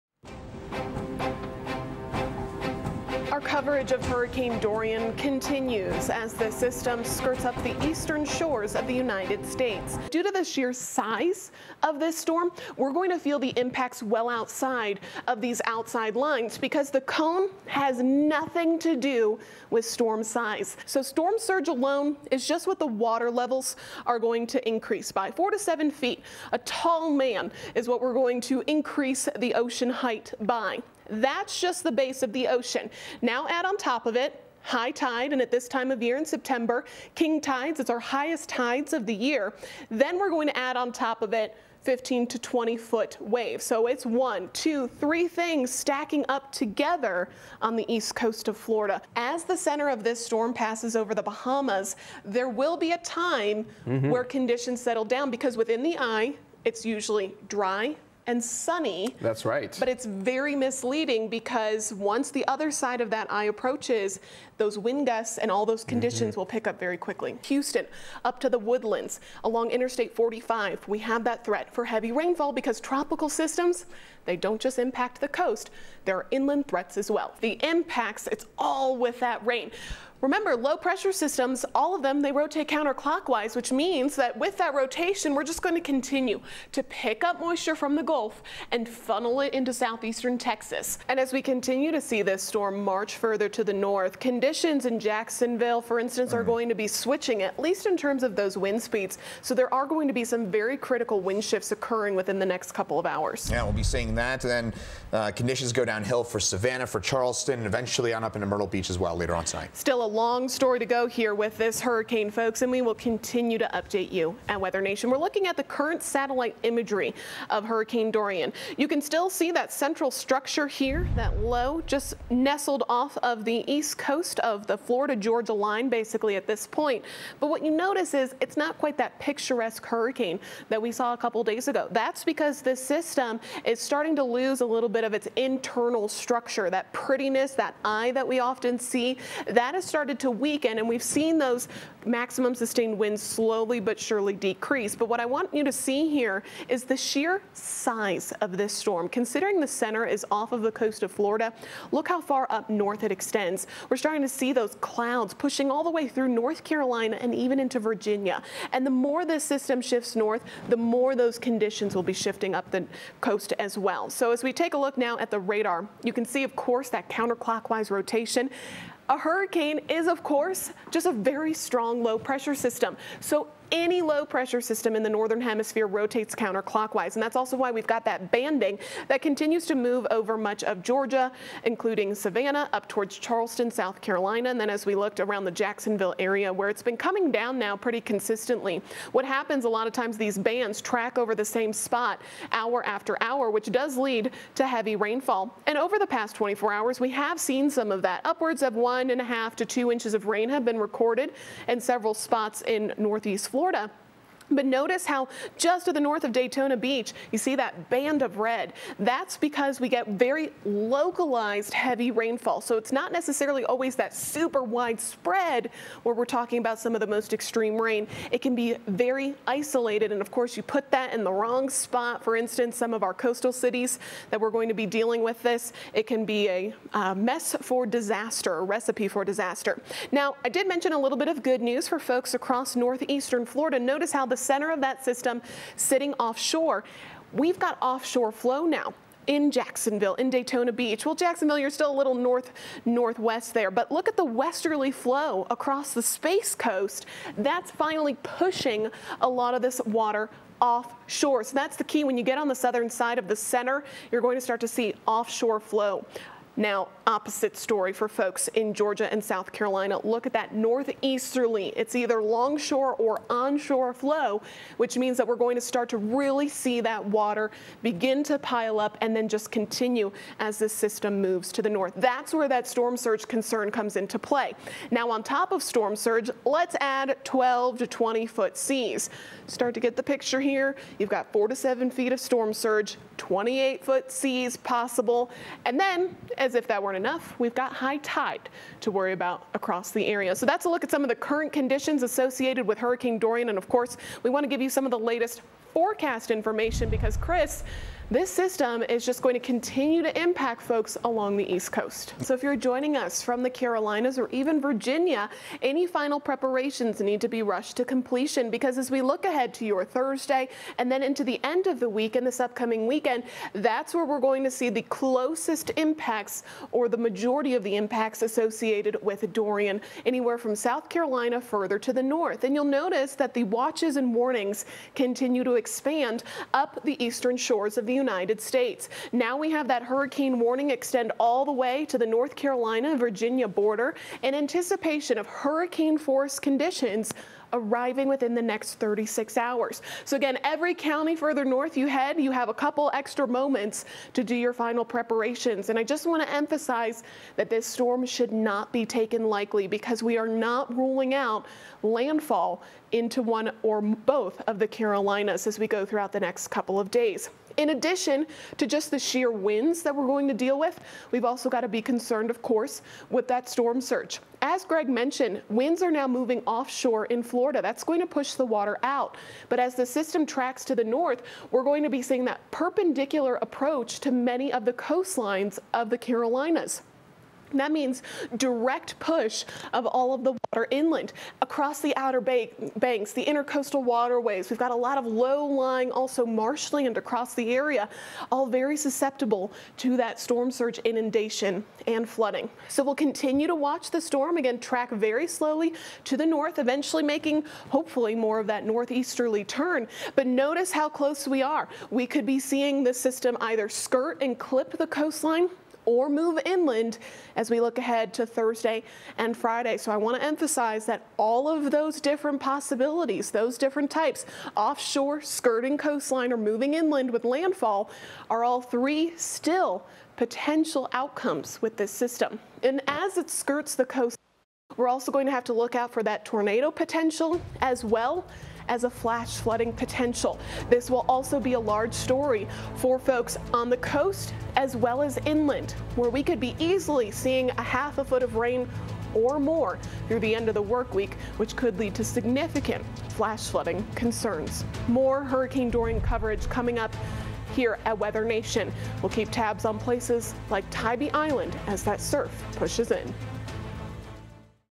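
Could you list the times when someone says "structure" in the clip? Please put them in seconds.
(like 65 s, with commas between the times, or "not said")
120 s, 136 s.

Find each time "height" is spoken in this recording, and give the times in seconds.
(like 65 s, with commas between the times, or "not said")
29 s.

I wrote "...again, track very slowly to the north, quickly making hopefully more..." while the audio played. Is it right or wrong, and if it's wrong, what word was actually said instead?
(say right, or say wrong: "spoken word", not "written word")
wrong: "eventually", not "quickly".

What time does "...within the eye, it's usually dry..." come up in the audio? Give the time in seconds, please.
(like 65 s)
55 s.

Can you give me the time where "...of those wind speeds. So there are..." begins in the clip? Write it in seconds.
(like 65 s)
98 s.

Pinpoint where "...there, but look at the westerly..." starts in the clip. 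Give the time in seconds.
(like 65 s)
243 s.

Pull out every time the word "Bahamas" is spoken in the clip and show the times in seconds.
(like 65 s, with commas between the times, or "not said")
51 s.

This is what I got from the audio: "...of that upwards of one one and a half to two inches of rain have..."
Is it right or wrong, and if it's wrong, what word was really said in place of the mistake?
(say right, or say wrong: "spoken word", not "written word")
right.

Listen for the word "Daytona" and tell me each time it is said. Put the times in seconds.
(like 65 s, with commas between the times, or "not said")
206 s, 240 s.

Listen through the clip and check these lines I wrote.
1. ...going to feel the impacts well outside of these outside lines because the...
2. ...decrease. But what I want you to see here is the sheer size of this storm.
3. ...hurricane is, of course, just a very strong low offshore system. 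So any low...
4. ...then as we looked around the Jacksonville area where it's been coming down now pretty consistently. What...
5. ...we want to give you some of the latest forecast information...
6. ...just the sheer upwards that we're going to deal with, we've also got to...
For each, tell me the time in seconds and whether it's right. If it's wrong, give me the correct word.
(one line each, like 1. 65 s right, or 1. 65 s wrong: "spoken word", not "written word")
1. 12 s right
2. 144 s right
3. 169 s wrong: "pressure", not "offshore"
4. 184 s right
5. 294 s right
6. 358 s wrong: "winds", not "upwards".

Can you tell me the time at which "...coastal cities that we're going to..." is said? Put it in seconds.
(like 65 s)
223 s.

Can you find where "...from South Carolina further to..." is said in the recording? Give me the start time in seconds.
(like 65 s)
320 s.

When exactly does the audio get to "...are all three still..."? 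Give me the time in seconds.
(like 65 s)
418 s.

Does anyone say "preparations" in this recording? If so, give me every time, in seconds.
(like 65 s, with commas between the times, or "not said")
306 s, 344 s.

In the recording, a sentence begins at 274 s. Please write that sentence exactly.
Now, on top of storm surge, let's add 12 to 20 foot seas.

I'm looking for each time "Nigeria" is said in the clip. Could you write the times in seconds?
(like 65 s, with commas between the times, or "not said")
not said.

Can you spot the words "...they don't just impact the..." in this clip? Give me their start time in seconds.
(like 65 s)
74 s.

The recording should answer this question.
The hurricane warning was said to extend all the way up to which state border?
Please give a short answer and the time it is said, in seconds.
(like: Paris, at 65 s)
North Carolina Virginia border, at 332 s.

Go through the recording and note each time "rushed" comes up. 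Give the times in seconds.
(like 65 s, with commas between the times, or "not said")
307 s.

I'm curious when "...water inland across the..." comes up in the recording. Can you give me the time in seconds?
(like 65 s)
380 s.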